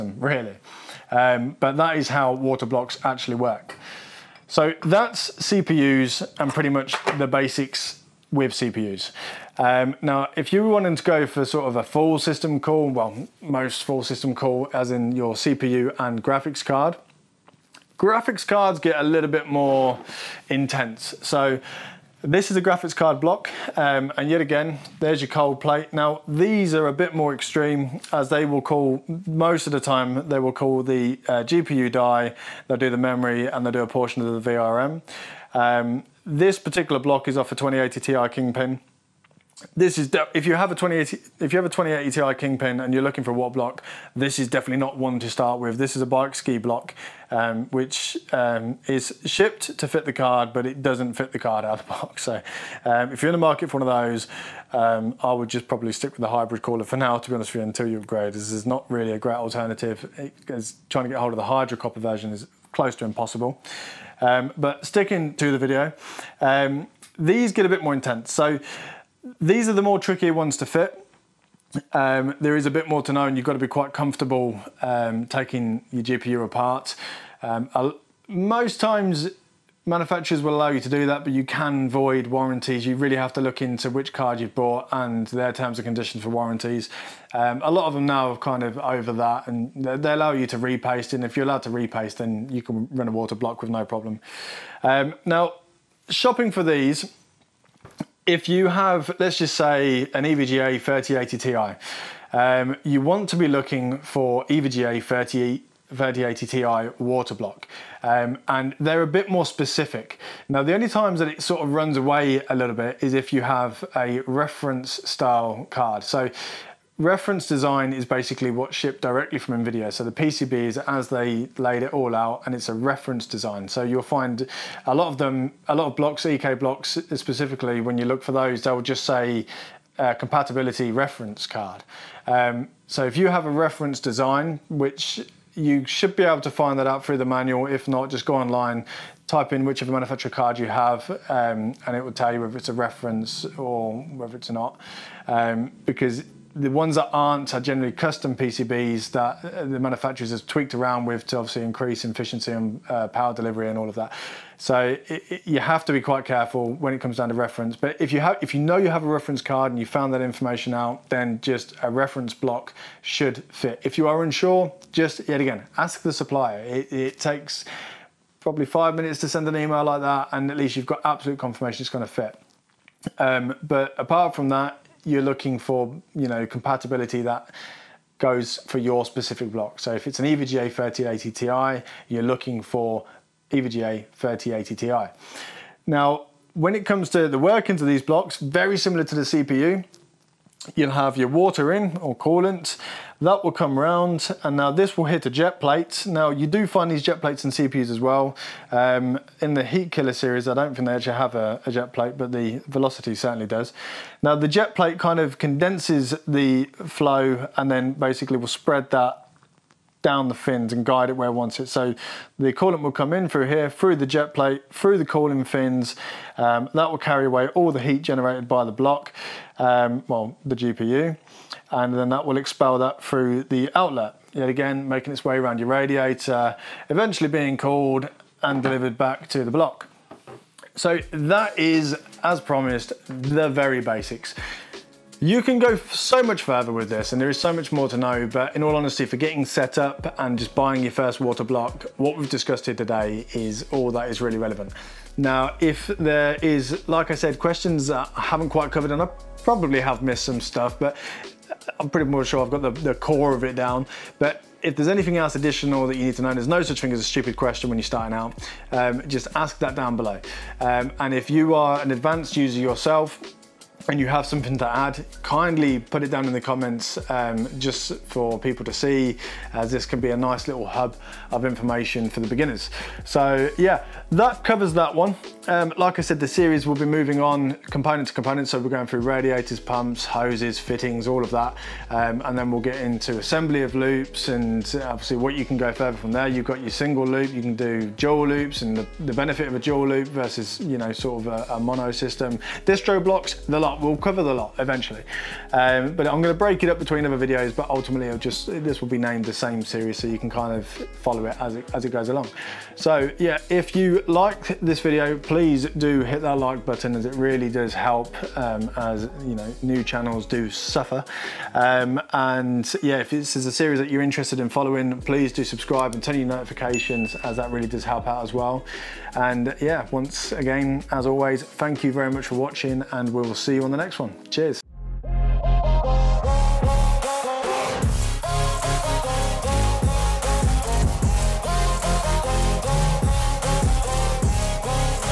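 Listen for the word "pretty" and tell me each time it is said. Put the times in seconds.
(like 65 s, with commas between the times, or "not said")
6 s, 251 s.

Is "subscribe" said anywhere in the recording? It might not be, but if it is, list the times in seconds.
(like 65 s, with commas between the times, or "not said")
315 s.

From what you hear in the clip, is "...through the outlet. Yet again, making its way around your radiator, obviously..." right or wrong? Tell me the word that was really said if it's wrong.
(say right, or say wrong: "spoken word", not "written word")
wrong: "eventually", not "obviously".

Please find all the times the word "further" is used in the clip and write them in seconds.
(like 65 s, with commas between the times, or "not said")
236 s, 285 s.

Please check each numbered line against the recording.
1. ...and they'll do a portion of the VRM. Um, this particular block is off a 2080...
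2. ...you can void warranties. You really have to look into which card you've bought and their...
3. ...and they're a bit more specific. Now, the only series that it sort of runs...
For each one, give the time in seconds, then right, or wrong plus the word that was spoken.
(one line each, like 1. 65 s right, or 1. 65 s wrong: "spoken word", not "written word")
1. 33 s right
2. 81 s right
3. 108 s wrong: "times", not "series".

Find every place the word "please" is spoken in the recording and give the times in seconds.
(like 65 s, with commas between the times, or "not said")
305 s, 315 s.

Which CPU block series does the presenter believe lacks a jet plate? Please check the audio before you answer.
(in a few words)
Heatkiller.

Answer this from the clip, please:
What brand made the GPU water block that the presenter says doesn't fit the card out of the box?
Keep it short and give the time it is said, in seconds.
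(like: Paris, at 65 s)
Bykski, at 46 s.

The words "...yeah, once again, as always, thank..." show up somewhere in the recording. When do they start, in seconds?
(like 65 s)
319 s.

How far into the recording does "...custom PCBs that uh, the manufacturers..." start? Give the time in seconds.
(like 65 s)
147 s.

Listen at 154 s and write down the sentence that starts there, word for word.
So it, it, you have to be quite careful when it comes down to reference.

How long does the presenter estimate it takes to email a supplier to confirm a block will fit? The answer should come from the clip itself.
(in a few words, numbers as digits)
5 minutes.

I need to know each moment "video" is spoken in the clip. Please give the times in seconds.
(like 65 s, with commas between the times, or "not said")
65 s, 297 s, 304 s.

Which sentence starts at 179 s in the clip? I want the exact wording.
So if it's an EVGA 3080 Ti, you're looking for EVGA 3080 Ti.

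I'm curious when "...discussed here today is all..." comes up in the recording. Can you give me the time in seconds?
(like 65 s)
242 s.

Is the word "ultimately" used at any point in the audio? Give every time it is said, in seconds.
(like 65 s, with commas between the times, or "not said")
297 s.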